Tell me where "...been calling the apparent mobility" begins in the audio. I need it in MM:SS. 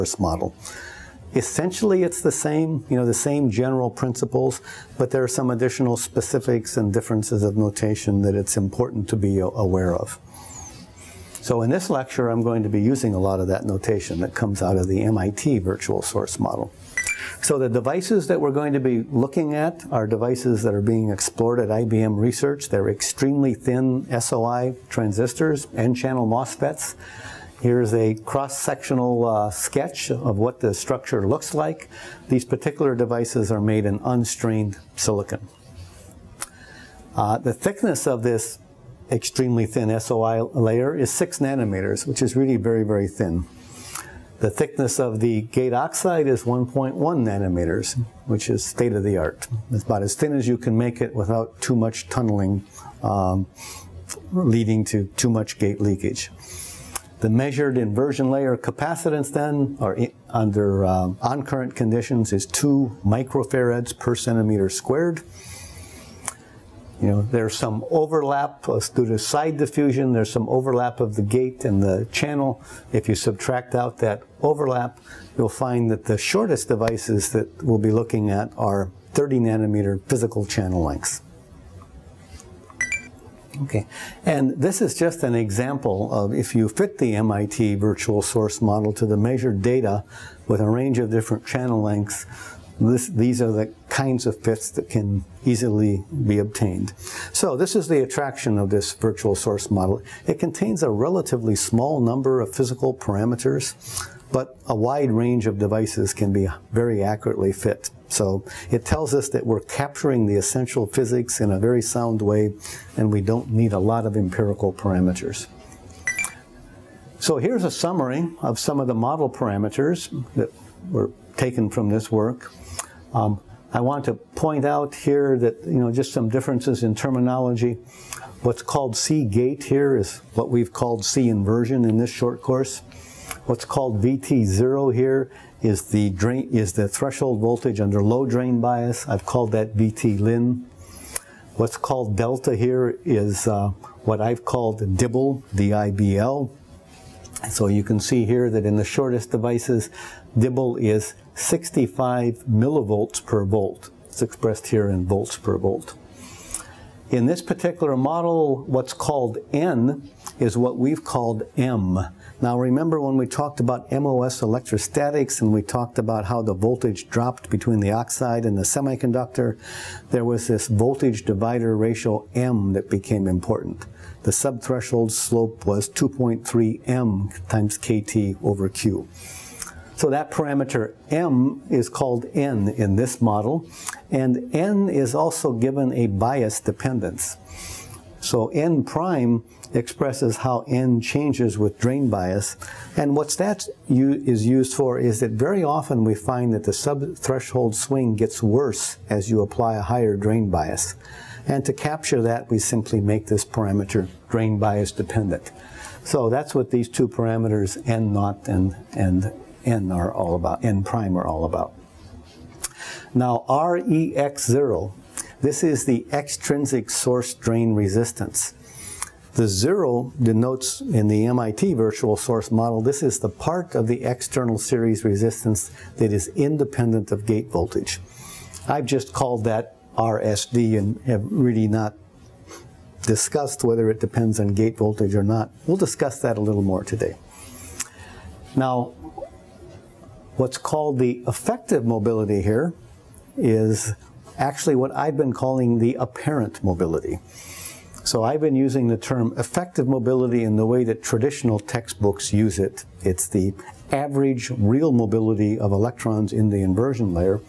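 04:05.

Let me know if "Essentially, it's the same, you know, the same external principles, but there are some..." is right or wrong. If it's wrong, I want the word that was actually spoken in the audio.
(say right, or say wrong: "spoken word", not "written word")
wrong: "general", not "external".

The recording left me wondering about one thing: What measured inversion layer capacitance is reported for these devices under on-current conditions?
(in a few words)
2 microfarads per centimeter squared.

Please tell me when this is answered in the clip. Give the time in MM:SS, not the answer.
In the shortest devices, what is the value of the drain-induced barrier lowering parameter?
02:31.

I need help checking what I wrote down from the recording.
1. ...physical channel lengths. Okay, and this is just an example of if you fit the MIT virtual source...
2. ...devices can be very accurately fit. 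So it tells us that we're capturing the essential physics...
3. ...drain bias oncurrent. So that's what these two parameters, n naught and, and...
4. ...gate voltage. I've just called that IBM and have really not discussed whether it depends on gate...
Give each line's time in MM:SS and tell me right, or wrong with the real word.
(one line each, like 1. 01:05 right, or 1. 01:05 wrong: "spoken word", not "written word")
1. 01:20 right
2. 01:45 right
3. 03:24 wrong: "dependent", not "oncurrent"
4. 03:47 wrong: "RSD", not "IBM".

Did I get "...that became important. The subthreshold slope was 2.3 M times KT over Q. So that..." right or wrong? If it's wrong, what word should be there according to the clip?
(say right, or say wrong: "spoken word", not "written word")
right.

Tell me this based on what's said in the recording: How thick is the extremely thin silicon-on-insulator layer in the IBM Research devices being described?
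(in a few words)
6 nanometers.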